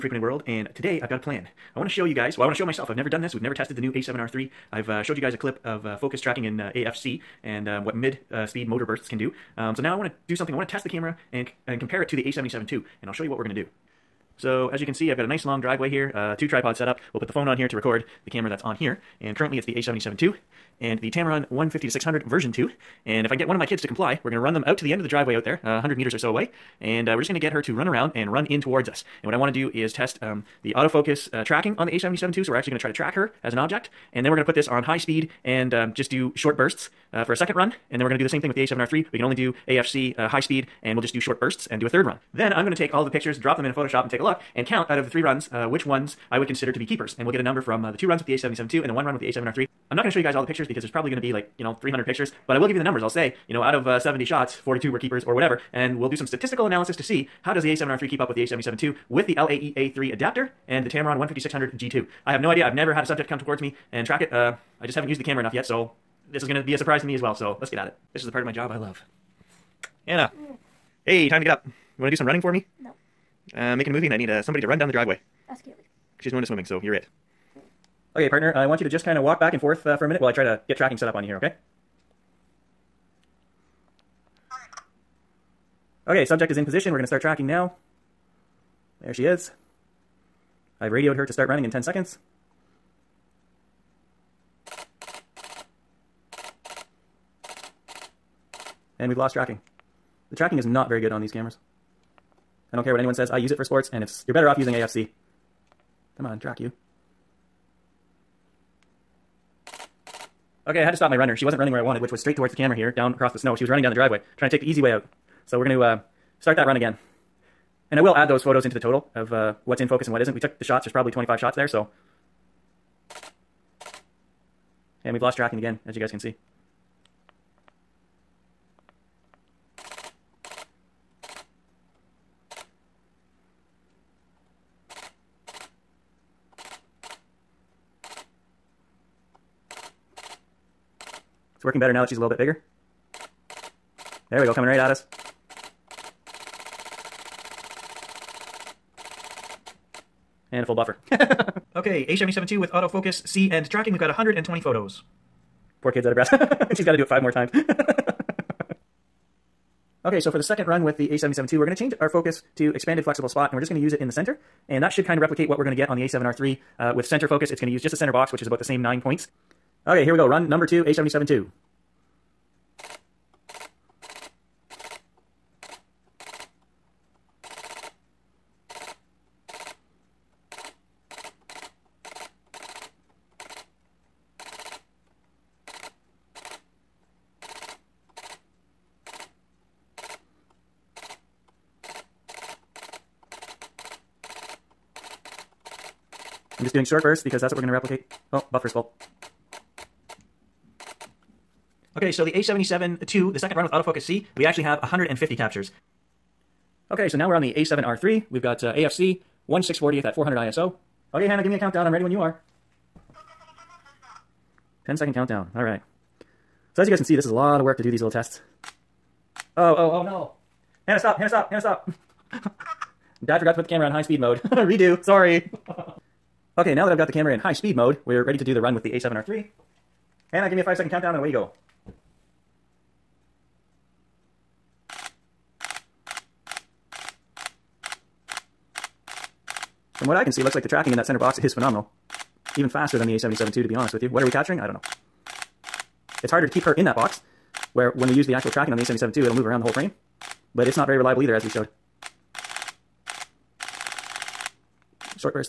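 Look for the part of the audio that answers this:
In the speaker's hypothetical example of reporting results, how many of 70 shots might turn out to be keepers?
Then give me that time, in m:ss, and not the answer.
0:54.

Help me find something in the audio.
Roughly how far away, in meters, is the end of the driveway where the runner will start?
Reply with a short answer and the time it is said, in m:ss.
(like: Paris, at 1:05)
100 meters, at 0:25.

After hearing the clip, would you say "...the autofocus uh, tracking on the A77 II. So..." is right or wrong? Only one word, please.
right.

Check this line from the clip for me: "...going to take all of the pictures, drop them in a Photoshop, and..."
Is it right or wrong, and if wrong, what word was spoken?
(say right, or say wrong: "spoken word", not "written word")
right.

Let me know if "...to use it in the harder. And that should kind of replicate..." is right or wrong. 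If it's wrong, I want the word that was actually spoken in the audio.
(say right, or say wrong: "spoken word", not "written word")
wrong: "center", not "harder".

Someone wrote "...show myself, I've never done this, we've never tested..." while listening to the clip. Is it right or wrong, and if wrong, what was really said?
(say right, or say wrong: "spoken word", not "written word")
right.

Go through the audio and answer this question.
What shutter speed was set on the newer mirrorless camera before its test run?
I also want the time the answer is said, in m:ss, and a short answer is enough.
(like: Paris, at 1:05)
1/640th, at 3:29.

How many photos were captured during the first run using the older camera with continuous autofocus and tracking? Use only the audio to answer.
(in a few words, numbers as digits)
120.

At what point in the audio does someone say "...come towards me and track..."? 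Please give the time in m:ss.
1:03.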